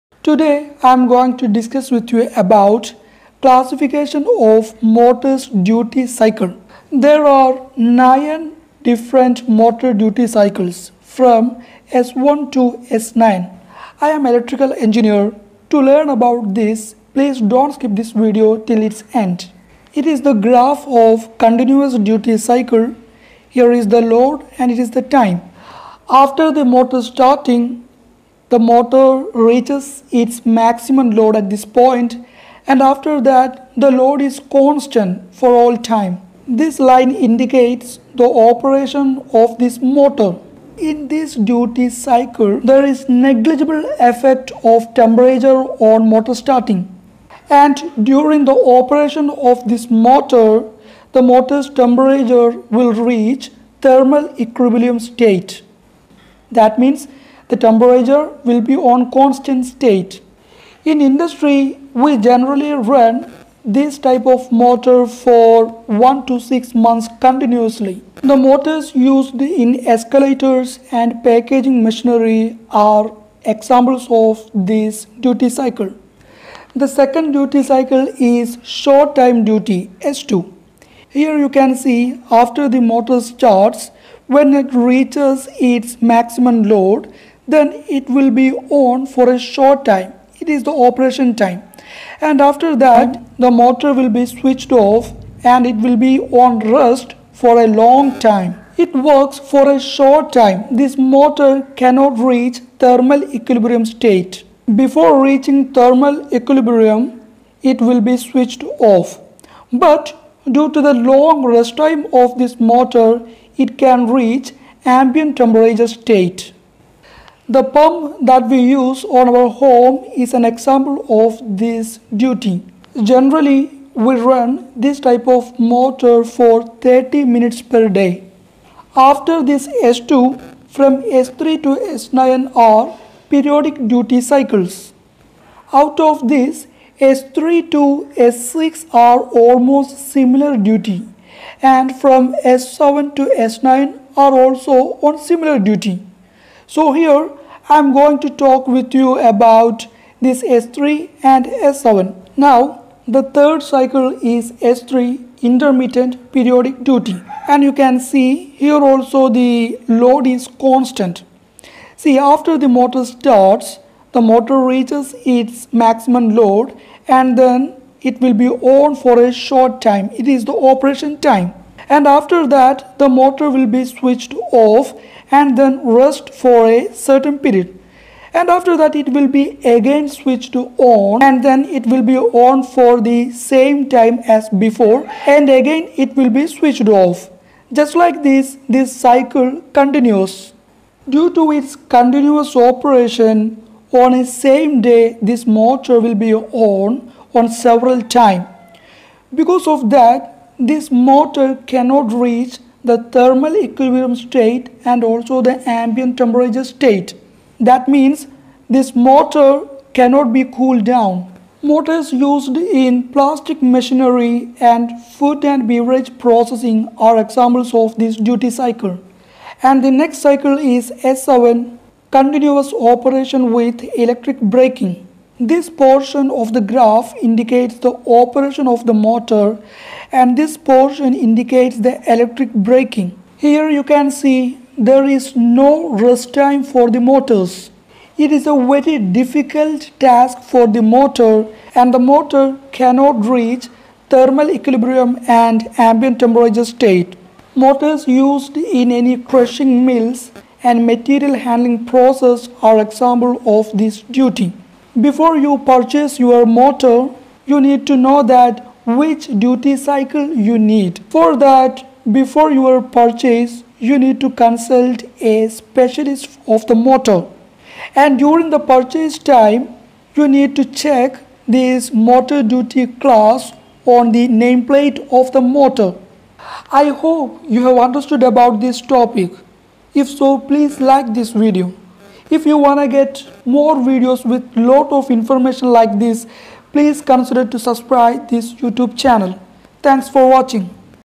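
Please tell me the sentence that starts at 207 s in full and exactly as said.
That means this motor cannot be cooled down.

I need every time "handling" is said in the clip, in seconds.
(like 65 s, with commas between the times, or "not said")
251 s.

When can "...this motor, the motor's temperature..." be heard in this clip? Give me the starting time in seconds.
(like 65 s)
49 s.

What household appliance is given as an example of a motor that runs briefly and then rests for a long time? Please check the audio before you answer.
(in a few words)
pump.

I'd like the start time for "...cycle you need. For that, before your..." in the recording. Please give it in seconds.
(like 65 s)
259 s.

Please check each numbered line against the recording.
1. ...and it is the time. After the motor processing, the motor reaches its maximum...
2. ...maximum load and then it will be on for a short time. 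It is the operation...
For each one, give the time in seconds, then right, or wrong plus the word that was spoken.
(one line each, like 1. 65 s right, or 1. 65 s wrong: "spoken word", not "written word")
1. 24 s wrong: "starting", not "processing"
2. 165 s right.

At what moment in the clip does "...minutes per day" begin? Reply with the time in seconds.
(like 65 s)
127 s.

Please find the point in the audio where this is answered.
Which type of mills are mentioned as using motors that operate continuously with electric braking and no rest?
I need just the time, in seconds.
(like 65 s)
249 s.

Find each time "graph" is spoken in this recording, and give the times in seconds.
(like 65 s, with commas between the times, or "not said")
20 s, 226 s.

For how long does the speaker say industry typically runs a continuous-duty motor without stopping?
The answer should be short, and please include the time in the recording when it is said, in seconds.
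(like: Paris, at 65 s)
1 to 6 months, at 66 s.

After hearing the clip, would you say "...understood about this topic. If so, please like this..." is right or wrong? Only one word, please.
right.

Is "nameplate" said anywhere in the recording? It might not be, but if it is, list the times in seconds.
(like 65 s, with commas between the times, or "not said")
274 s.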